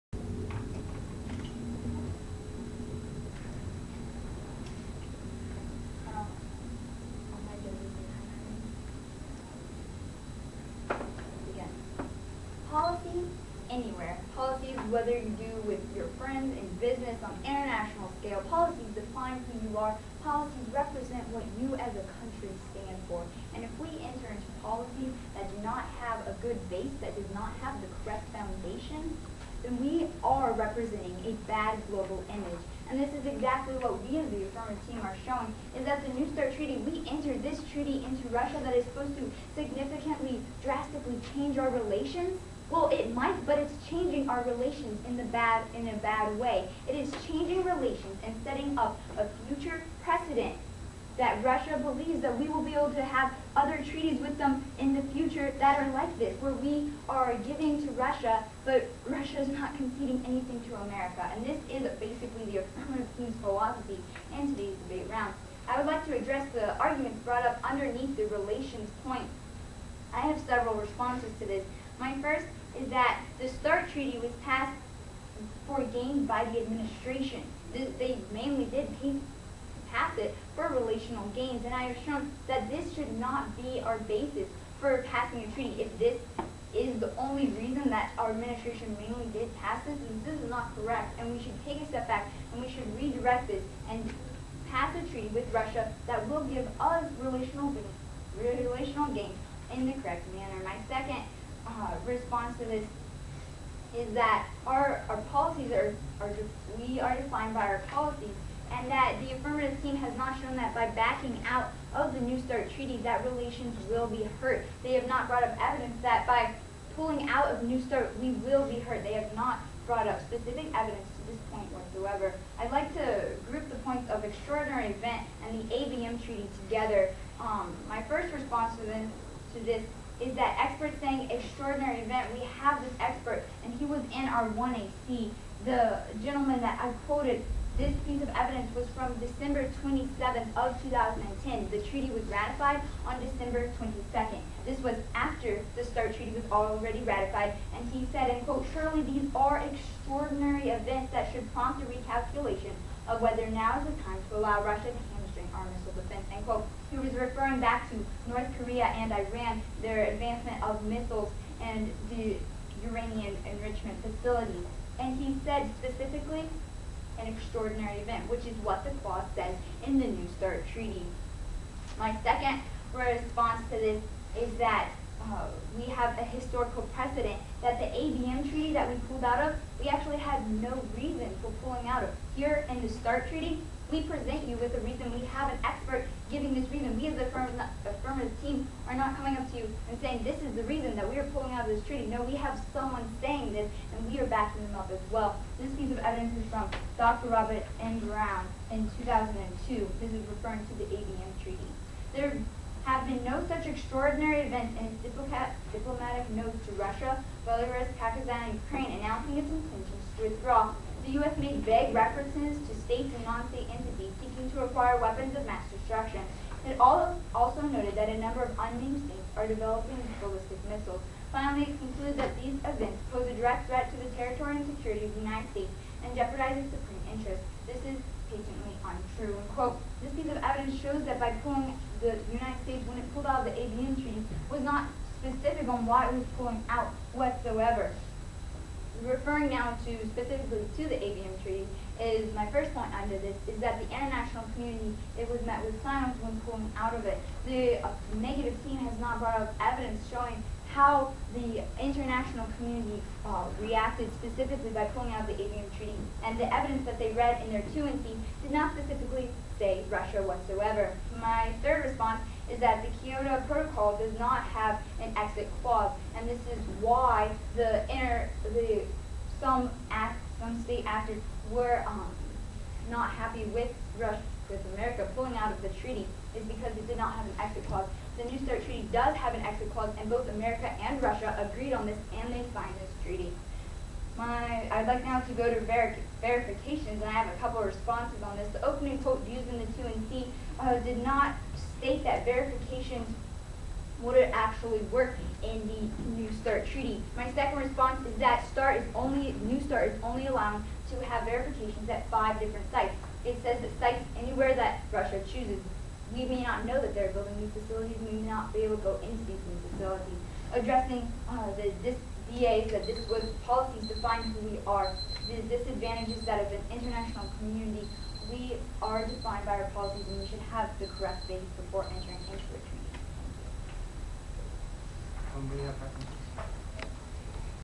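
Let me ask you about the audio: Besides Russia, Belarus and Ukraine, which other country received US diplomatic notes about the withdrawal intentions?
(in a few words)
Pakistan.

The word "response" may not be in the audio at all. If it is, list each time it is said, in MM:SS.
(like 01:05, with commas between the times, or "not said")
01:10, 01:42, 02:08, 02:52, 04:21, 04:47, 04:57.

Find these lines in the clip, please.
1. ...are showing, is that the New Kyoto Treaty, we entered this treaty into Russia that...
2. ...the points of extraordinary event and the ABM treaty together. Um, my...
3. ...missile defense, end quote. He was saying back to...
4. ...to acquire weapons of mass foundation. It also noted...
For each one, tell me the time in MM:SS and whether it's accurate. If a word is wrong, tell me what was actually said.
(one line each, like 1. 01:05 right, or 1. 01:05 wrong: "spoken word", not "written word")
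1. 00:35 wrong: "START", not "Kyoto"
2. 02:03 right
3. 02:35 wrong: "referring", not "saying"
4. 03:34 wrong: "destruction", not "foundation".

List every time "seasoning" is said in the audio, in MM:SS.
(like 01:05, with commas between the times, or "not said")
not said.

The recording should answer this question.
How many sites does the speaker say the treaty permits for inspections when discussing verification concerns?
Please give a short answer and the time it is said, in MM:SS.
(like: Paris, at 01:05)
5, at 05:02.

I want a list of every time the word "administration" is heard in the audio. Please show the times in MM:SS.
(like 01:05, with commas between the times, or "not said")
01:16, 01:28.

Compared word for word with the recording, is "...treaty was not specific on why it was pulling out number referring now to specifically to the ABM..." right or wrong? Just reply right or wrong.
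wrong.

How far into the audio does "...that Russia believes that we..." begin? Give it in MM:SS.
00:51.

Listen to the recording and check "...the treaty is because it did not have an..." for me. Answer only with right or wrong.
right.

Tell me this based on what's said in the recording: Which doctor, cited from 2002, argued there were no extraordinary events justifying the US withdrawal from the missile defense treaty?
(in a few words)
Dr. Robert N. Brown.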